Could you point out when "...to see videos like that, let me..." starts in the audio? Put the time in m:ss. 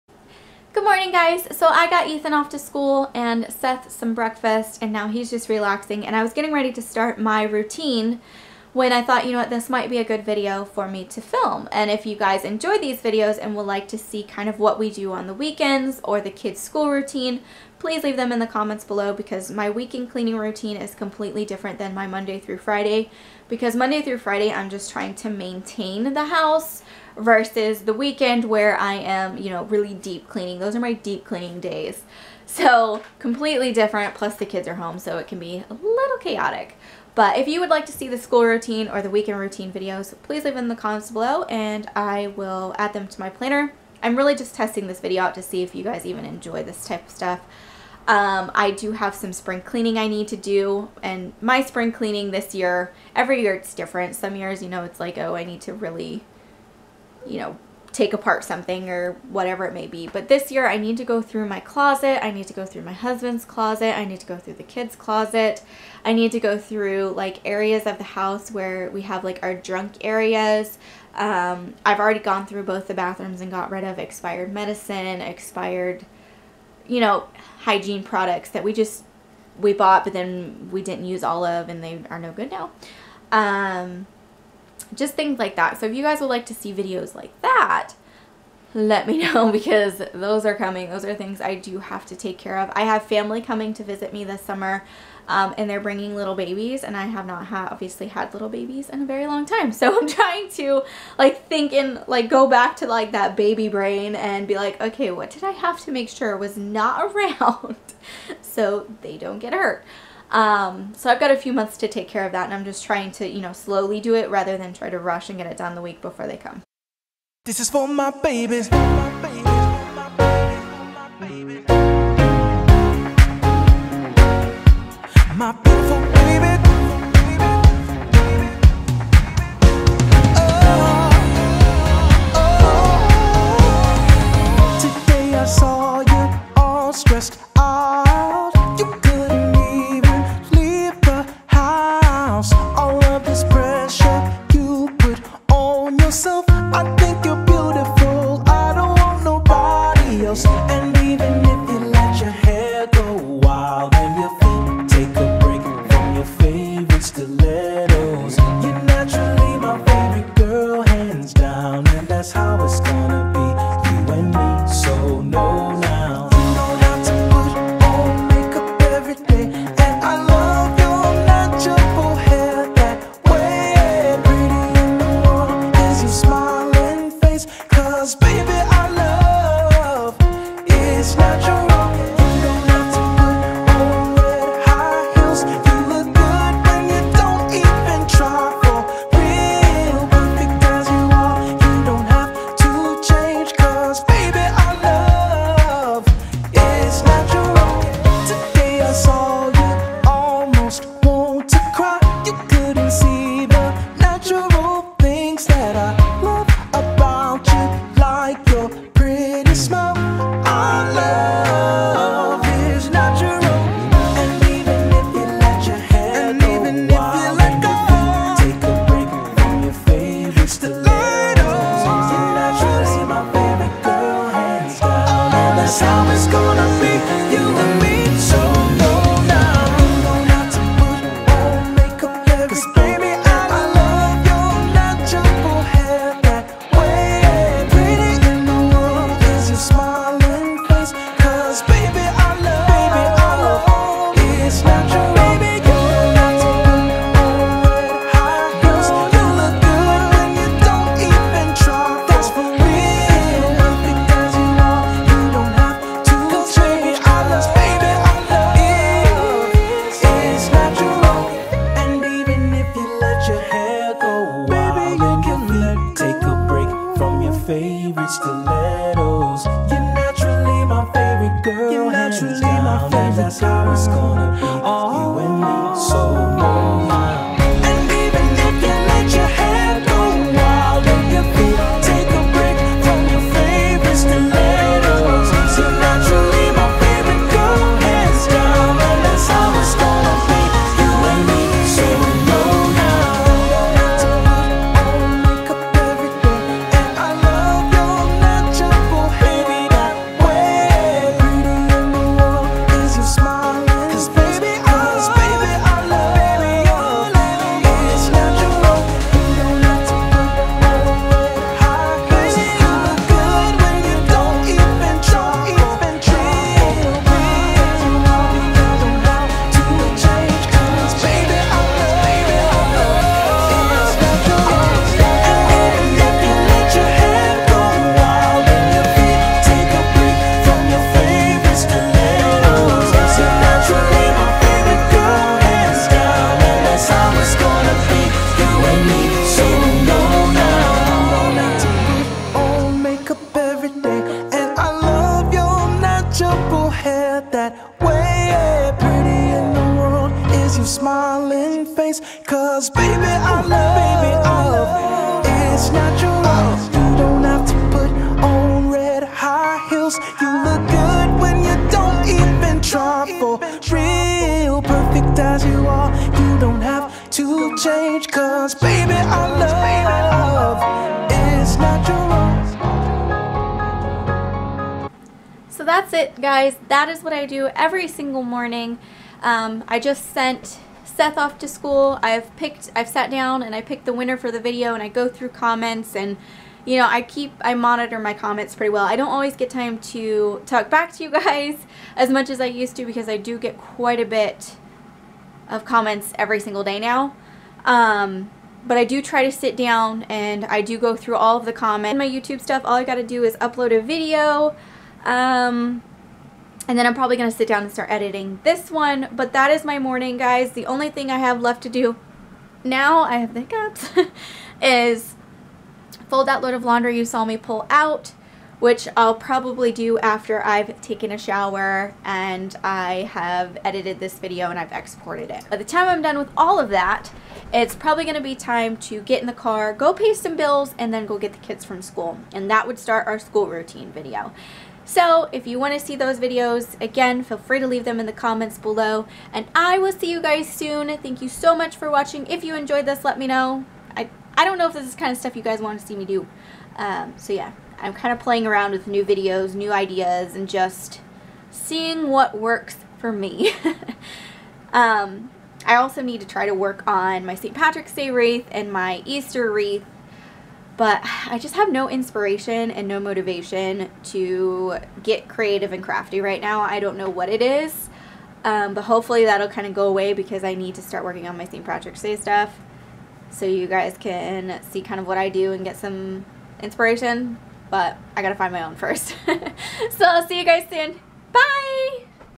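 1:26.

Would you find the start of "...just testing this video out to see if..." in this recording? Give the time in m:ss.
0:44.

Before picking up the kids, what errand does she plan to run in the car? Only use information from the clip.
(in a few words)
Pay some bills.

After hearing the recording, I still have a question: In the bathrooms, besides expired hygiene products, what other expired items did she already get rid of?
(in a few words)
Medicine.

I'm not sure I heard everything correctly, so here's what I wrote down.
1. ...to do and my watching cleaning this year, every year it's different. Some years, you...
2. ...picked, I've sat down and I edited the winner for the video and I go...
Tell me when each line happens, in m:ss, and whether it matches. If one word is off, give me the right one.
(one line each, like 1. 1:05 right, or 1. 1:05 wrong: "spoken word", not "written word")
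1. 0:50 wrong: "spring", not "watching"
2. 6:22 wrong: "picked", not "edited".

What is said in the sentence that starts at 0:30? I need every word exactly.
Those are my deep cleaning days.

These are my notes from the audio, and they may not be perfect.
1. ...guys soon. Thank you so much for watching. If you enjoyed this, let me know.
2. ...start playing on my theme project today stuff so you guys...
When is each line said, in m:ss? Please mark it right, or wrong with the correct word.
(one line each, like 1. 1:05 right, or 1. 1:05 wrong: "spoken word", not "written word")
1. 7:20 right
2. 7:50 wrong: "working", not "playing".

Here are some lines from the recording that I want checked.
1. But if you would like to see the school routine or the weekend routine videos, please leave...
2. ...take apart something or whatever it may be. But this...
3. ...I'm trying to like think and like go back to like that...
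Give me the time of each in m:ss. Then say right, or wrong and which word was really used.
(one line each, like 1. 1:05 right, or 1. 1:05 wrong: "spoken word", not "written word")
1. 0:37 right
2. 0:57 right
3. 1:39 right.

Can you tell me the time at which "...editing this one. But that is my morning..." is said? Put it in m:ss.
6:47.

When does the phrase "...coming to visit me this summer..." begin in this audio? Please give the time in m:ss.
1:33.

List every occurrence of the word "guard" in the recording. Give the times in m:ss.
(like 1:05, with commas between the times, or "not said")
not said.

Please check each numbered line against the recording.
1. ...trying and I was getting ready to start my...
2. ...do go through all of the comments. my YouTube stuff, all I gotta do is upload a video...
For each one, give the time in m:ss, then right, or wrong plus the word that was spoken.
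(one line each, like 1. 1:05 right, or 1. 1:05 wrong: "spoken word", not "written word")
1. 0:05 wrong: "relaxing", not "trying"
2. 6:40 right.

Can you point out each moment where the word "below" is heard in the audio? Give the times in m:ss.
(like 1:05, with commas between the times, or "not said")
0:18, 0:41, 7:18.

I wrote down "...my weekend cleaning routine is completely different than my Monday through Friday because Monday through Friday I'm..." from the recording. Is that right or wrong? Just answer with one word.
right.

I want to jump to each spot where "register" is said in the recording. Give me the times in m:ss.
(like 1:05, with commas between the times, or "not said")
not said.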